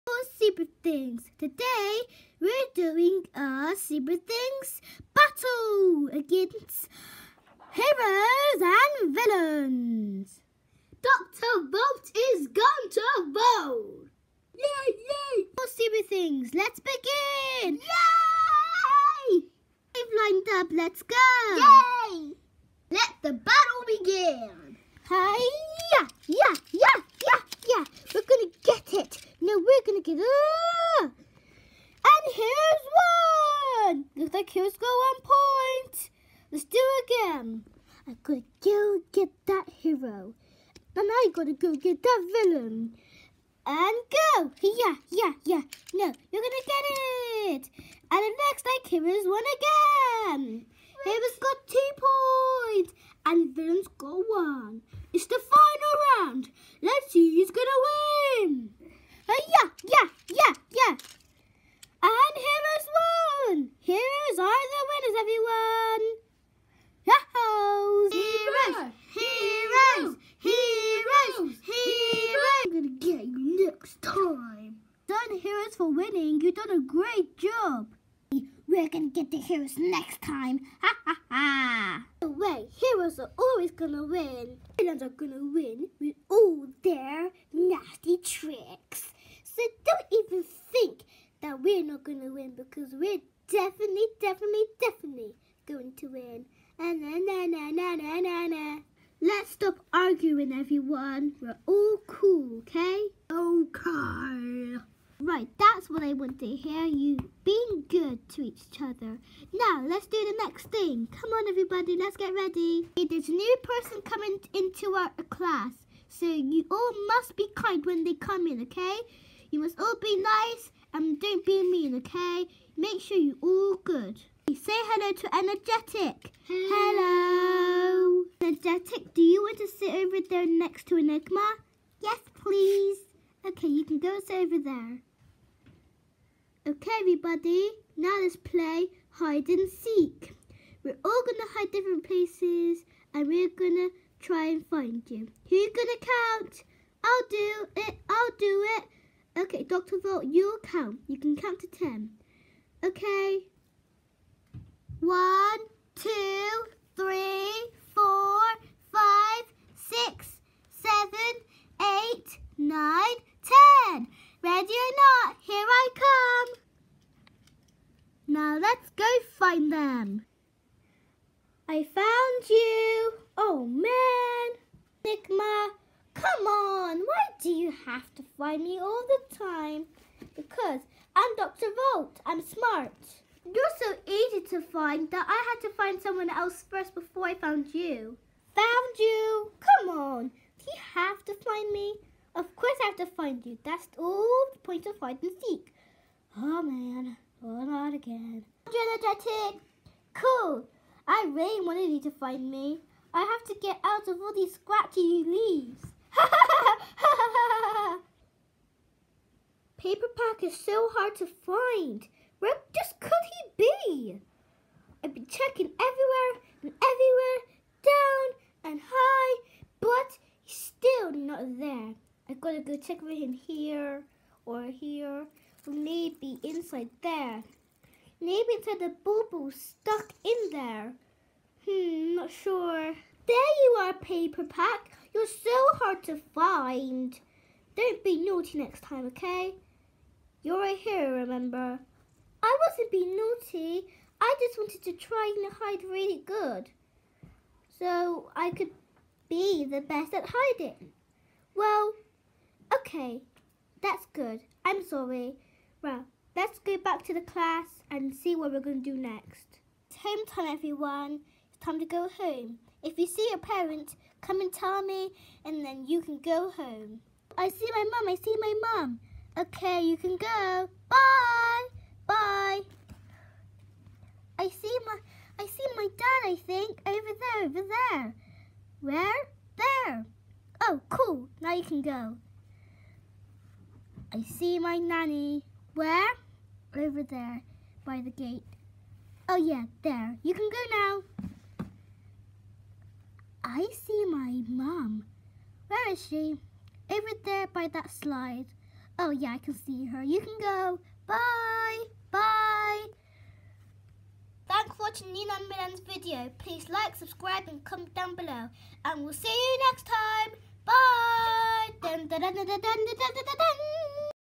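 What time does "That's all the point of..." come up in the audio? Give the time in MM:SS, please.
03:13.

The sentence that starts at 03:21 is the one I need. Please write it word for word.
I really wanted you to find me.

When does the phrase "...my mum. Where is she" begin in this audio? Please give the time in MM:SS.
04:54.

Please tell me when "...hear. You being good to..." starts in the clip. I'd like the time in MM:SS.
01:46.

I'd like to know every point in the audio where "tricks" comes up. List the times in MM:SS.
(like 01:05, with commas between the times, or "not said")
01:28.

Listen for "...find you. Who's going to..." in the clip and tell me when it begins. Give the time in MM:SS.
02:24.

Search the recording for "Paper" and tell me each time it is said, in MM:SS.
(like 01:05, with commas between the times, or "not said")
03:29, 03:53.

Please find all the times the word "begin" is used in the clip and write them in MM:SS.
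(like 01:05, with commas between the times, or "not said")
00:16, 00:23.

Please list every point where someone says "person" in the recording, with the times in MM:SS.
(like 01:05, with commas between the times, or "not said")
01:53.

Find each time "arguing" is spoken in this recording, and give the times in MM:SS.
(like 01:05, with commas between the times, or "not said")
01:39.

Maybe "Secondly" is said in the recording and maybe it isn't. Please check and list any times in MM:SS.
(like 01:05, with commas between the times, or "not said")
not said.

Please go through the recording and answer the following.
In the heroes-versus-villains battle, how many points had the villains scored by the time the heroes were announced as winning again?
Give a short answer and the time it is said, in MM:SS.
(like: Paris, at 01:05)
1, at 00:53.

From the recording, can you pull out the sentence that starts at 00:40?
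And I gotta go get that villain.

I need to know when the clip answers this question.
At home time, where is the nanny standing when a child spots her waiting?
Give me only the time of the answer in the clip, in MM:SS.
04:47.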